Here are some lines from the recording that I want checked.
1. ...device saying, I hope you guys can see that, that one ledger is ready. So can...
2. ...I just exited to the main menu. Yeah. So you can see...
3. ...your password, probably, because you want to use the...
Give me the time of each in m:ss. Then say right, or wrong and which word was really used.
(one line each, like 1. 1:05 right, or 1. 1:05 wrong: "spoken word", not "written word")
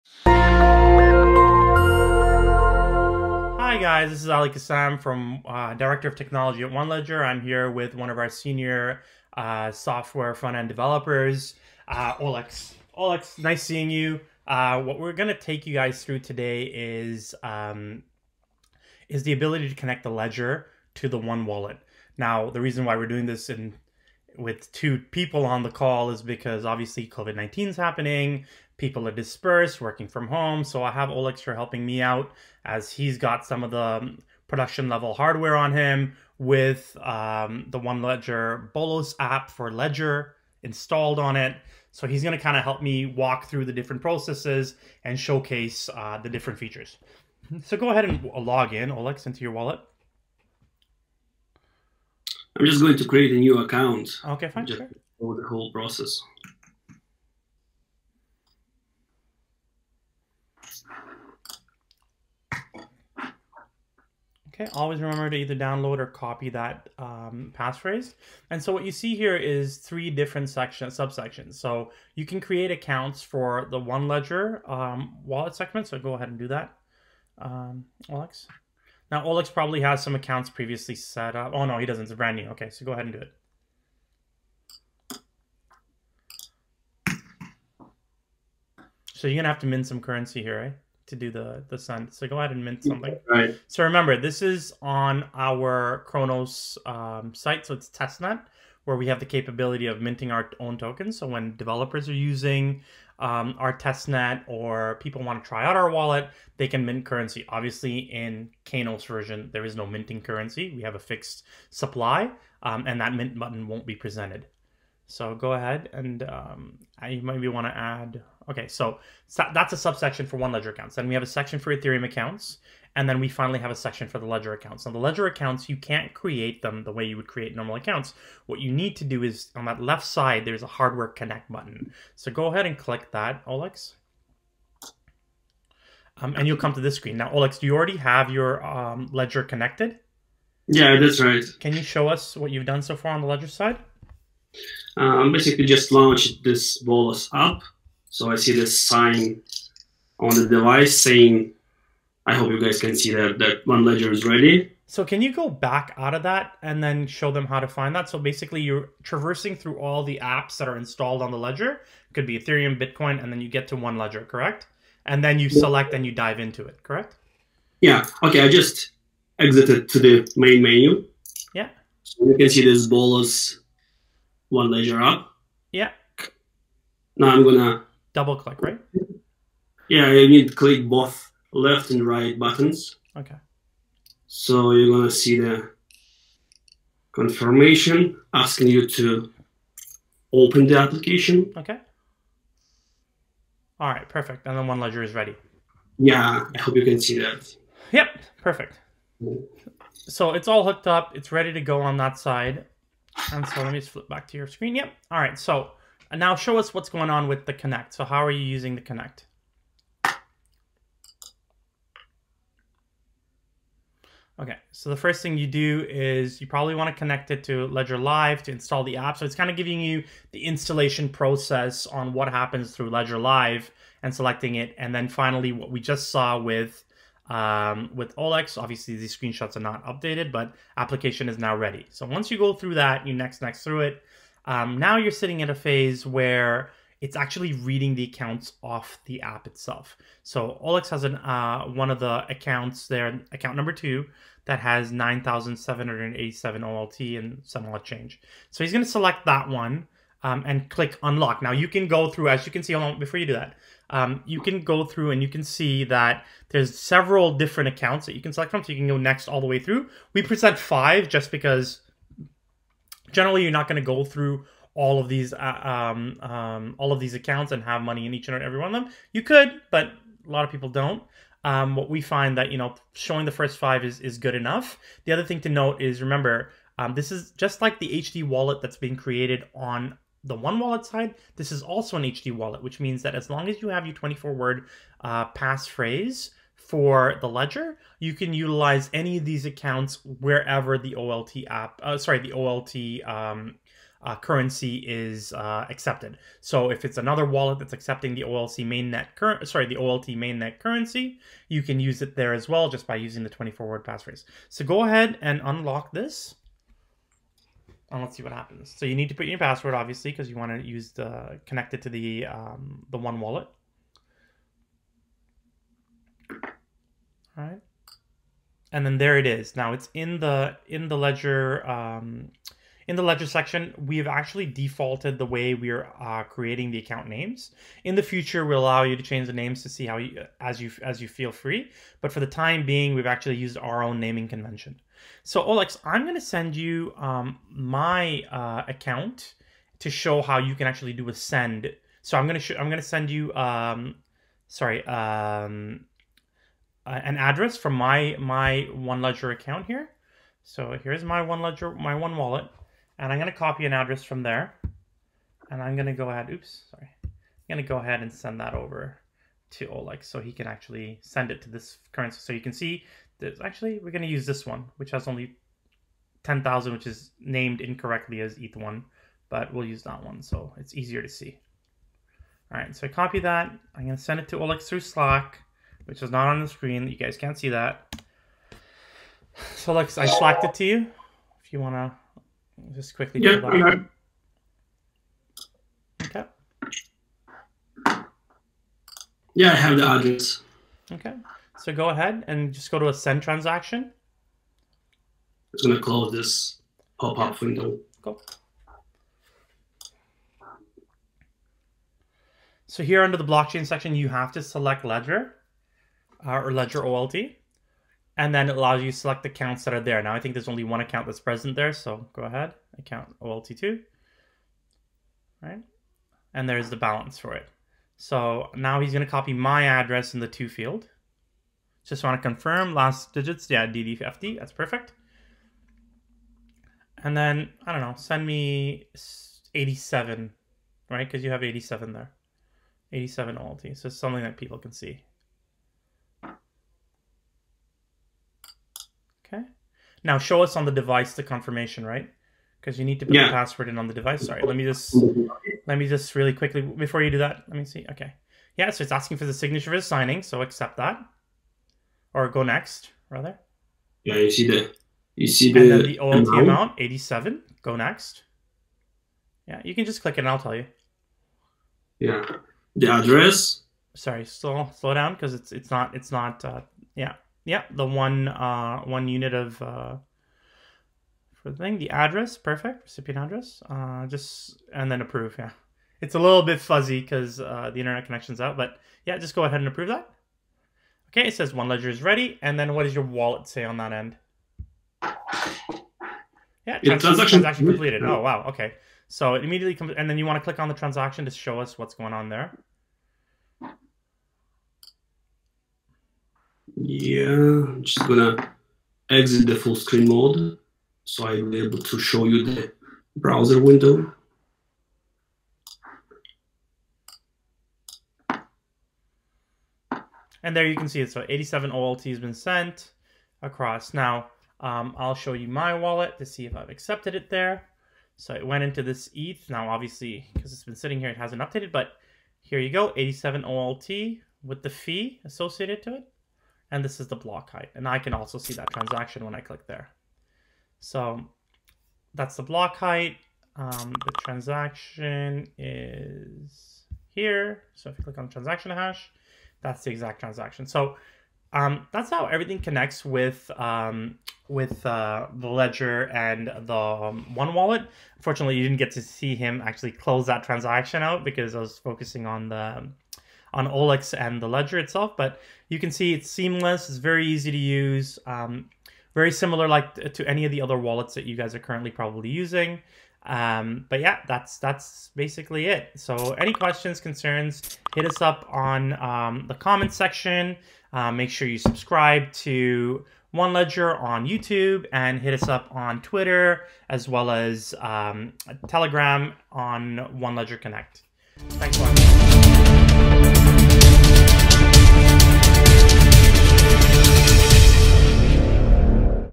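1. 2:30 right
2. 2:48 right
3. 5:09 wrong: "obviously", not "probably".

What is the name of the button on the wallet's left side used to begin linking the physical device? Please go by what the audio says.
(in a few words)
hardware connect.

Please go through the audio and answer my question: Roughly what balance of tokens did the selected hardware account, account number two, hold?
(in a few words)
9,787 OLT.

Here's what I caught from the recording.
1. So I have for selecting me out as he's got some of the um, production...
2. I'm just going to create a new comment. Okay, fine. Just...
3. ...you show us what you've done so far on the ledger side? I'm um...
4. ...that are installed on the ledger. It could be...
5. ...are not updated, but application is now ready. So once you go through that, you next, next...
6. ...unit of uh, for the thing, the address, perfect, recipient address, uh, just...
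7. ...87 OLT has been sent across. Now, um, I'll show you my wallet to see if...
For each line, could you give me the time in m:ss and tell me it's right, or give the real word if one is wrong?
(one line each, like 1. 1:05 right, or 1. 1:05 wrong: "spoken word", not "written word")
1. 0:30 wrong: "helping", not "selecting"
2. 0:52 wrong: "account", not "comment"
3. 2:21 right
4. 2:40 right
5. 3:49 right
6. 7:49 right
7. 8:31 right.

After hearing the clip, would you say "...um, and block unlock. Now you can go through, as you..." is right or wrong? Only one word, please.
wrong.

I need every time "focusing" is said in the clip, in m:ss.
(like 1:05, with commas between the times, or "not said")
9:11.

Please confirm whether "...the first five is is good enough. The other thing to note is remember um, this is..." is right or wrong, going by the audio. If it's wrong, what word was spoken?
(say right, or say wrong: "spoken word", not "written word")
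right.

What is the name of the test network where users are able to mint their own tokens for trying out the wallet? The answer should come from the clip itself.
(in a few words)
Kronos.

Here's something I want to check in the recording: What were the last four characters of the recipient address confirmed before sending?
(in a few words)
DDFD.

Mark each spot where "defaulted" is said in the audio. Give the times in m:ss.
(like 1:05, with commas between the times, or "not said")
5:24.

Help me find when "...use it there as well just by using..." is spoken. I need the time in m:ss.
5:01.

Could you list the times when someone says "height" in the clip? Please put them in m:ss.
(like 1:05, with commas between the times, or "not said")
8:47, 8:52.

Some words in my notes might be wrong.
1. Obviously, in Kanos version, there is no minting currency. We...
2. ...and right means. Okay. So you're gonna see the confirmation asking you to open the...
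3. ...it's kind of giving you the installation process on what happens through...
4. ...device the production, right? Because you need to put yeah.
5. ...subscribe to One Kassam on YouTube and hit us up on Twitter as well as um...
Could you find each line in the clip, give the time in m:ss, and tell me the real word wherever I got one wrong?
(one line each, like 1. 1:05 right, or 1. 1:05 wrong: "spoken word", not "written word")
1. 1:47 right
2. 3:01 wrong: "buttons", not "means"
3. 3:39 right
4. 7:20 wrong: "confirmation", not "production"
5. 9:31 wrong: "Ledger", not "Kassam".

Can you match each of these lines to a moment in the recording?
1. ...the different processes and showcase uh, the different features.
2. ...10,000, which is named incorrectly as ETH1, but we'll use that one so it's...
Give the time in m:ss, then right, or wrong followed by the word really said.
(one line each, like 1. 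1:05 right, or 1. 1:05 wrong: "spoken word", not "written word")
1. 0:43 right
2. 6:06 right.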